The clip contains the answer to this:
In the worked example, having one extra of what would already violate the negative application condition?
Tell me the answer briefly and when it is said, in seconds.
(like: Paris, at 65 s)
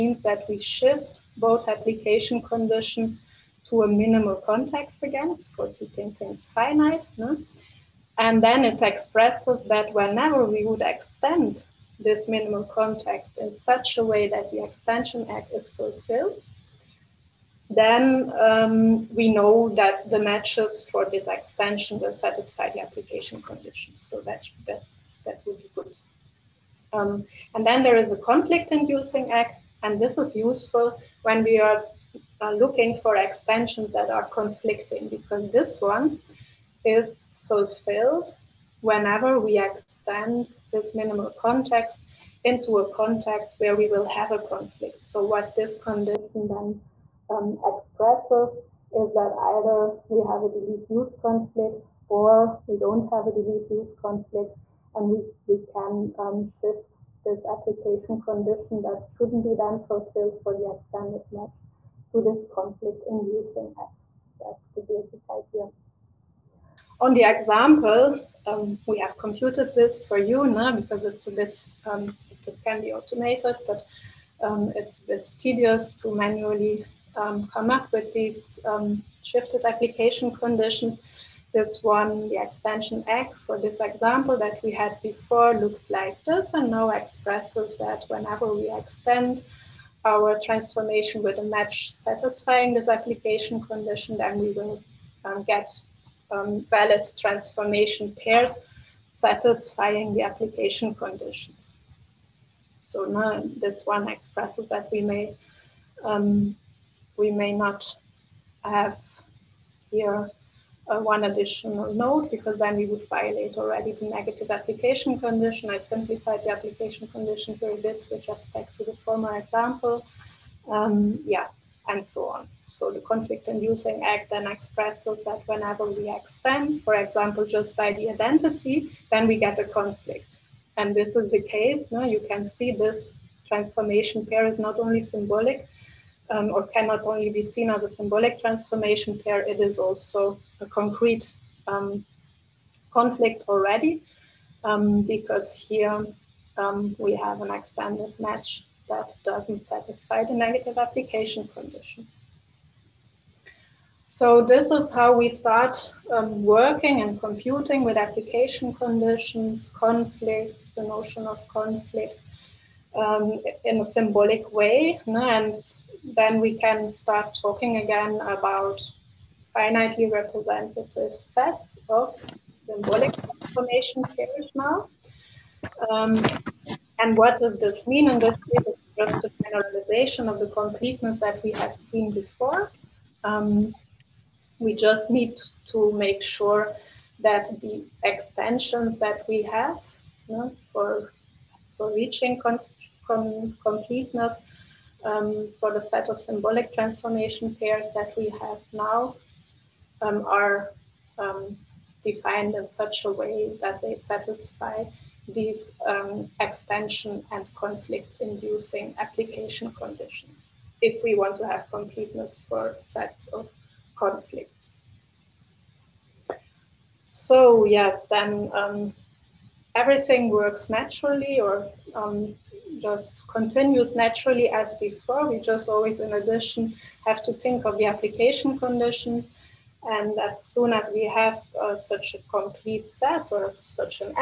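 node, at 111 s.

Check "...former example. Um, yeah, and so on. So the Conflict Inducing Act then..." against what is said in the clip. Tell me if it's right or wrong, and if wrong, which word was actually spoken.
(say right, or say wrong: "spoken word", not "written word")
right.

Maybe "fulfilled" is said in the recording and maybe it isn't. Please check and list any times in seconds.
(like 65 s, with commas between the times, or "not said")
15 s, 37 s, 59 s.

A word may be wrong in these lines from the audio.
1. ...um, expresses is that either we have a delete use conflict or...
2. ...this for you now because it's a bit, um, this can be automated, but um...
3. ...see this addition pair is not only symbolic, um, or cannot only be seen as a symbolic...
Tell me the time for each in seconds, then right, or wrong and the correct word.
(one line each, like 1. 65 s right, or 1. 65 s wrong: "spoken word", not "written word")
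1. 47 s right
2. 69 s right
3. 132 s wrong: "transformation", not "addition".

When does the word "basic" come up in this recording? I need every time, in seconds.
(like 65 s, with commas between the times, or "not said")
64 s.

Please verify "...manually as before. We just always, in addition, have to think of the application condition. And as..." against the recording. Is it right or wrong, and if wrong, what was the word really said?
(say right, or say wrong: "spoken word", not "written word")
wrong: "naturally", not "manually".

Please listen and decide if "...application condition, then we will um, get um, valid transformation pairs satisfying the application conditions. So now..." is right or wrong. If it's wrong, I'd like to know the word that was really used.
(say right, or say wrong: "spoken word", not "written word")
right.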